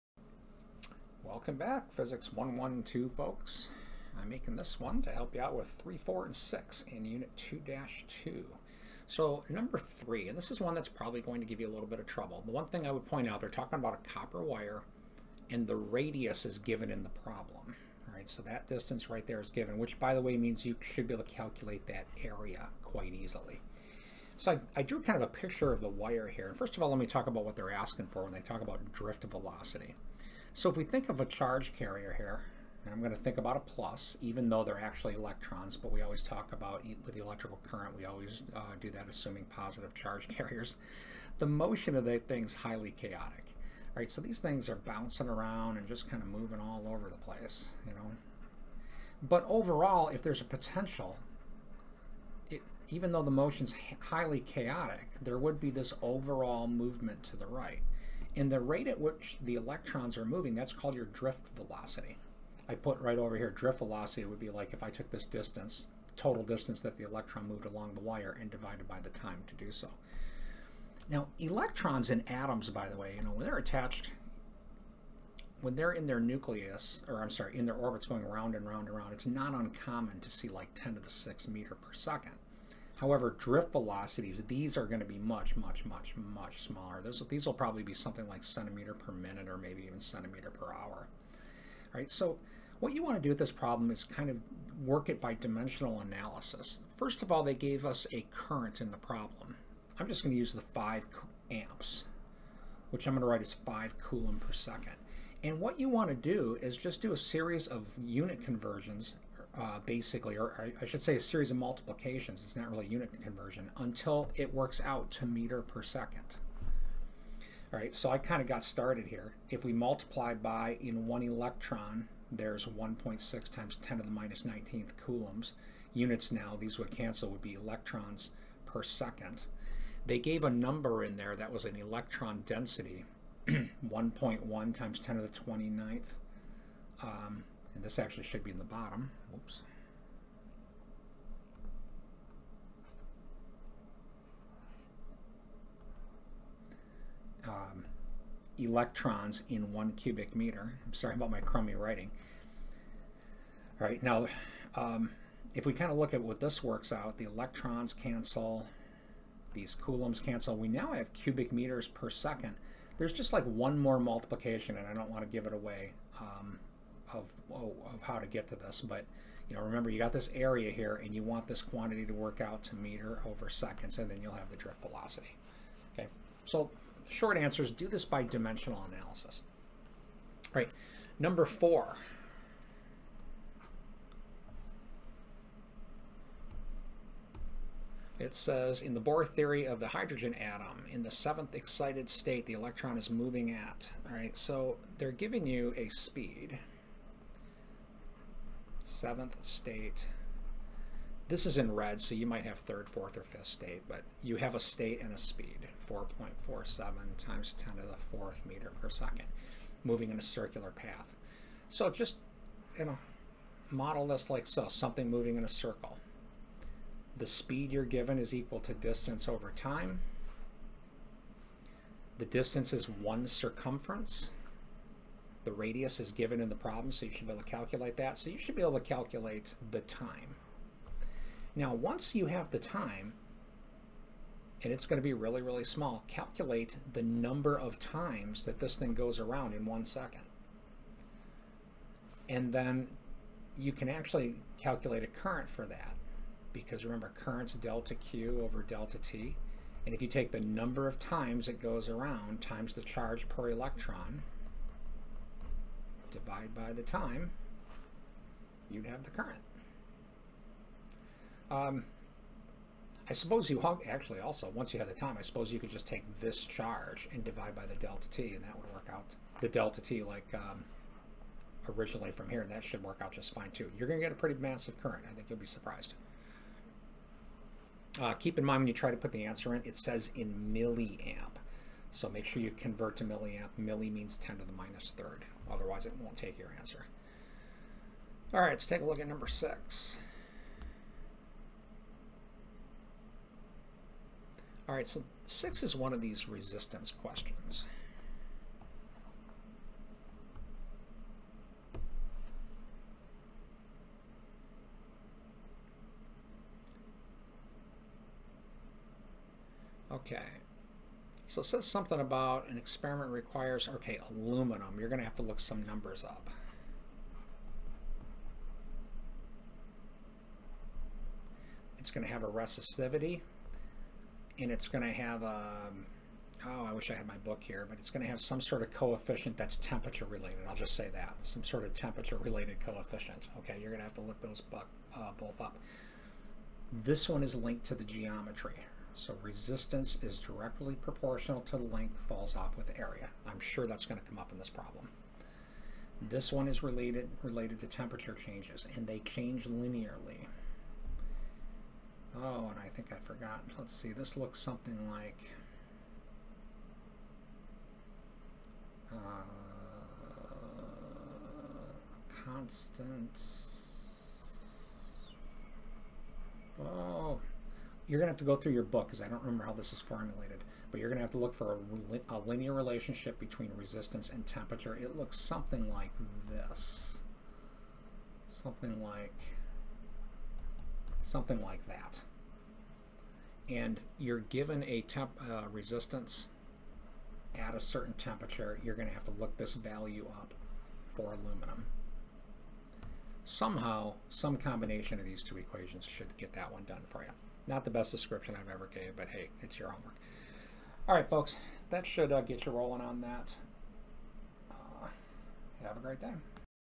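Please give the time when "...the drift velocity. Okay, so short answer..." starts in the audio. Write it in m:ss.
2:54.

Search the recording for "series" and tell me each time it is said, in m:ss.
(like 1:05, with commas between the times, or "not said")
1:47, 1:51.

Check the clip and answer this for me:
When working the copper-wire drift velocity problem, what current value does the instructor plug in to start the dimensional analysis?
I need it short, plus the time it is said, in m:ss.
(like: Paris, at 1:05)
5 amps, at 1:40.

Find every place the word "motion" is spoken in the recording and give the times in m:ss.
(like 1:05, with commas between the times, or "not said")
0:41, 0:53.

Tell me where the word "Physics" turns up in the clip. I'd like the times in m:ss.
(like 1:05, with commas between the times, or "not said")
0:01.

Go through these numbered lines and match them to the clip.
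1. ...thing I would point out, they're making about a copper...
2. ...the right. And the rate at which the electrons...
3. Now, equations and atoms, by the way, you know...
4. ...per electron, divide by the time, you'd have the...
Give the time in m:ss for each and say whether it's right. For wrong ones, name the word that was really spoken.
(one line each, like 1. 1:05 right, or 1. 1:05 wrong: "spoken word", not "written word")
1. 0:12 wrong: "talking", not "making"
2. 0:57 right
3. 1:11 wrong: "electrons", not "equations"
4. 4:13 right.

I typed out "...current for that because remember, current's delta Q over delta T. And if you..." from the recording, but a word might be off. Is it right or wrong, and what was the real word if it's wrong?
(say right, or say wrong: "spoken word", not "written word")
right.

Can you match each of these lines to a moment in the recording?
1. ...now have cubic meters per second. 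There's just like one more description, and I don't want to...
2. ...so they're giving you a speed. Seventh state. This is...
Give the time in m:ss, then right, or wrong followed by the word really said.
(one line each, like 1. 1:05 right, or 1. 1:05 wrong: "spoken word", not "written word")
1. 2:40 wrong: "multiplication", not "description"
2. 3:14 right.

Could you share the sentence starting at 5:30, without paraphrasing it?
I'll just say that, some sort of temperature related coefficient.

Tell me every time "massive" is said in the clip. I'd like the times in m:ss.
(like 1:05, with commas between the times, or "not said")
4:34.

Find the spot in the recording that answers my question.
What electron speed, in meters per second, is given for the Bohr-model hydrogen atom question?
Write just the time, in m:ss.
3:25.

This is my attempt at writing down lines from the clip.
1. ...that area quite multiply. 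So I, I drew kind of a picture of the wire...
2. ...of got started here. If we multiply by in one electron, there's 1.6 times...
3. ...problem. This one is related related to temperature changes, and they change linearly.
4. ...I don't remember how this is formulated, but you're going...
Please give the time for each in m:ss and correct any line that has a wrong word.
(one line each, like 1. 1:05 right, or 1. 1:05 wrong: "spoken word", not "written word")
1. 0:21 wrong: "easily", not "multiply"
2. 1:58 right
3. 5:44 right
4. 6:09 right.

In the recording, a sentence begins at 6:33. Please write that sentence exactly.
Somehow, some combination of these two equations should get that one done for you.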